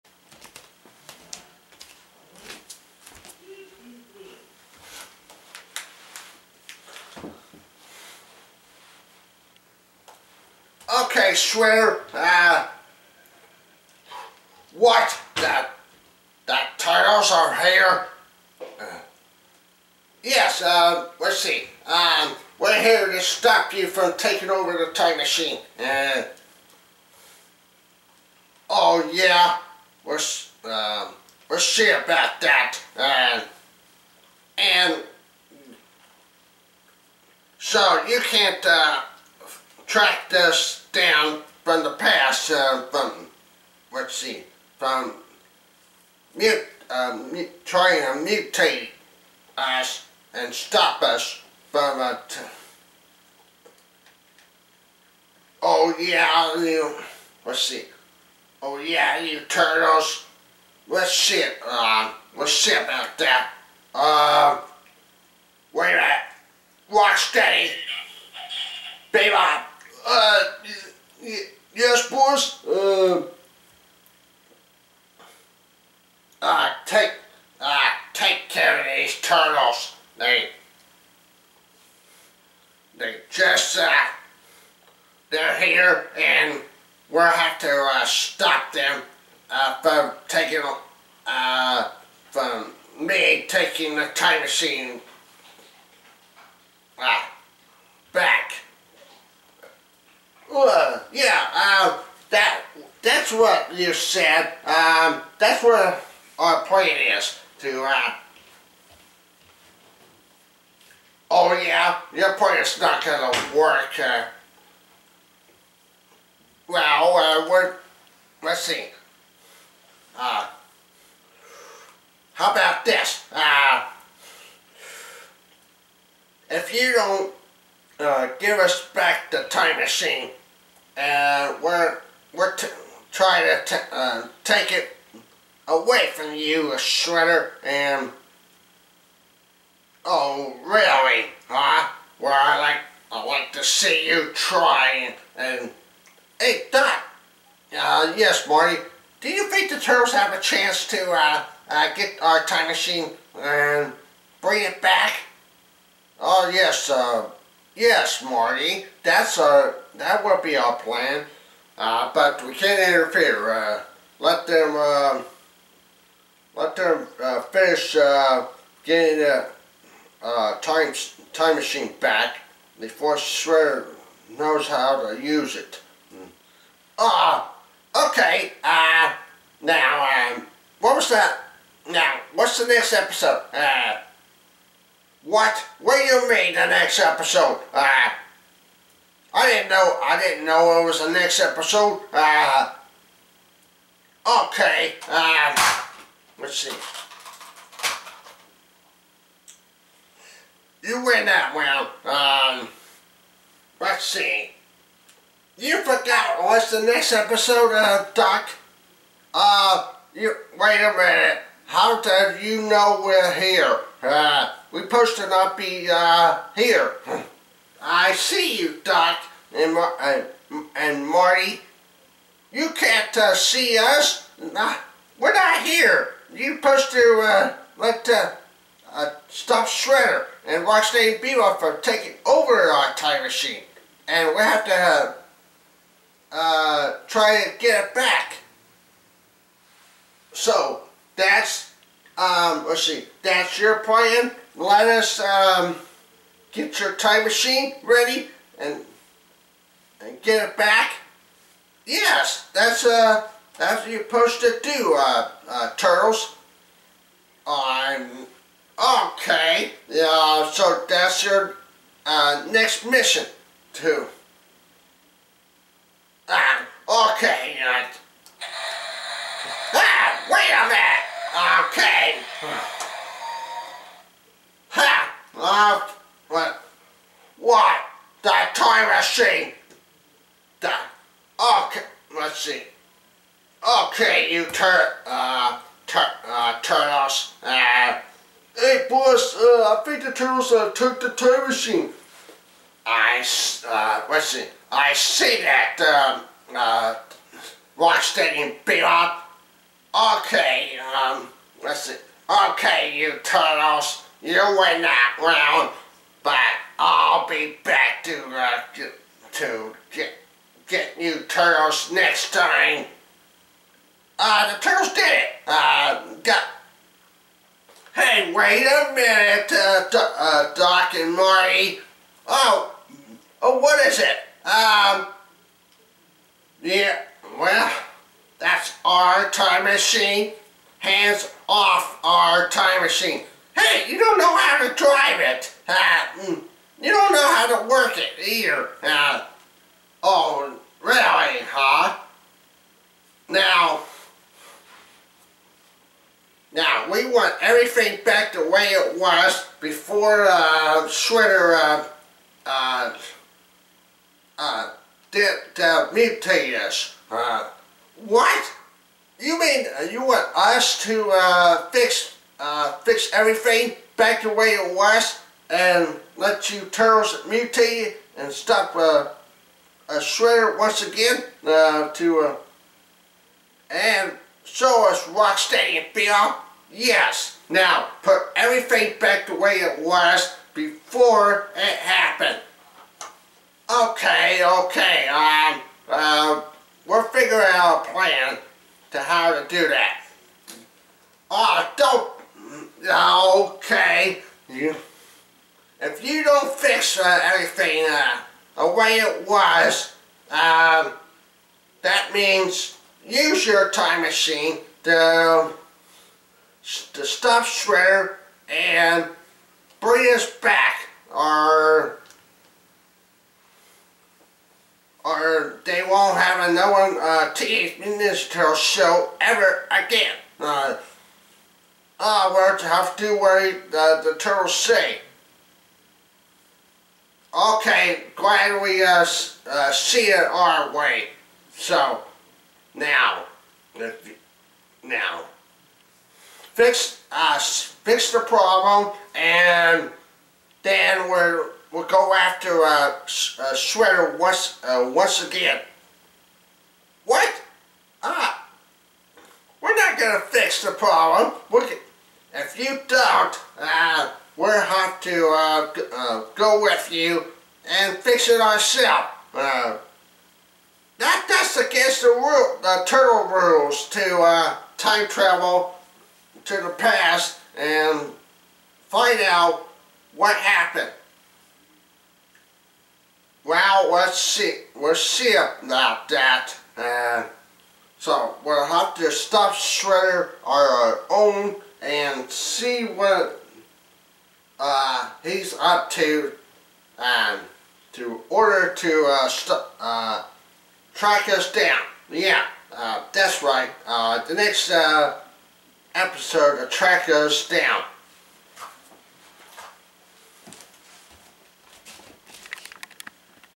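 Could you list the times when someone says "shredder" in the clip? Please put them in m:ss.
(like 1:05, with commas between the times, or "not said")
2:16, 2:53, 3:49, 6:09, 6:47, 7:24, 7:59.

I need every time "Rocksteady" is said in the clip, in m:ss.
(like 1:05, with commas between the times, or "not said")
1:06, 3:50, 4:57, 6:15.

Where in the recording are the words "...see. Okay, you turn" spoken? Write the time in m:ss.
4:42.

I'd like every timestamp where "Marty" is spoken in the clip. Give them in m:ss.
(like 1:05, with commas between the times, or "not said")
2:28, 2:38, 3:41, 5:21.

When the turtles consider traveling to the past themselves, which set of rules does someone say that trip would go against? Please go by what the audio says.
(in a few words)
the turtle rules.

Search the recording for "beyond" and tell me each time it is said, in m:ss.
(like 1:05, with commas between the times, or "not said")
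6:15.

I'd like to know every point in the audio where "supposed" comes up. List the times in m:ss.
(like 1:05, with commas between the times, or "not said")
3:34, 3:46, 4:14.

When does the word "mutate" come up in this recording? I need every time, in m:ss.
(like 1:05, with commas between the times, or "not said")
0:48, 5:55, 6:07.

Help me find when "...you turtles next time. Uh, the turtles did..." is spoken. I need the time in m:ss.
5:11.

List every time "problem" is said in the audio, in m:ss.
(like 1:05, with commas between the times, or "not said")
7:18, 7:30.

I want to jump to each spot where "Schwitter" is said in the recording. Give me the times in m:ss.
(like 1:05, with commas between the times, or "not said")
5:50.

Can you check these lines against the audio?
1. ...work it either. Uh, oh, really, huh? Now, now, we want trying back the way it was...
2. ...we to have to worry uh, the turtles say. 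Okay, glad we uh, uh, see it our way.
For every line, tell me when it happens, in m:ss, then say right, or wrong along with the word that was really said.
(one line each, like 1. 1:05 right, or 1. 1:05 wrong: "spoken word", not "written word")
1. 5:37 wrong: "everything", not "trying"
2. 7:02 right.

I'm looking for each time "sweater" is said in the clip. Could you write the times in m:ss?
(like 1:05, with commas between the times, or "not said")
0:11, 7:23.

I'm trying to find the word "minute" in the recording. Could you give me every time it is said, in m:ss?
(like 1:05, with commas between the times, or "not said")
1:05, 3:30, 4:30, 5:18.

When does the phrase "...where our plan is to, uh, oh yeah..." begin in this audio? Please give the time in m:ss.
1:45.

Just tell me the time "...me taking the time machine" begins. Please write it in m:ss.
1:32.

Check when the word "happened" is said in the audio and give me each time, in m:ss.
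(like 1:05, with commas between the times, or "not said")
6:21, 7:50.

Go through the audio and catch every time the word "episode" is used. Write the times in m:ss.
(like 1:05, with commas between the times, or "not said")
3:02, 3:06, 3:11, 3:27, 8:15.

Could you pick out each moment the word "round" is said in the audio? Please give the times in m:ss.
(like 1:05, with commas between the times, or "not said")
3:21, 5:05.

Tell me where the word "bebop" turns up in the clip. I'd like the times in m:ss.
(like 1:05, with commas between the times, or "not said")
1:09, 3:51.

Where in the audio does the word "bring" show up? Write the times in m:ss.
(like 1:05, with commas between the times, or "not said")
2:34, 6:49.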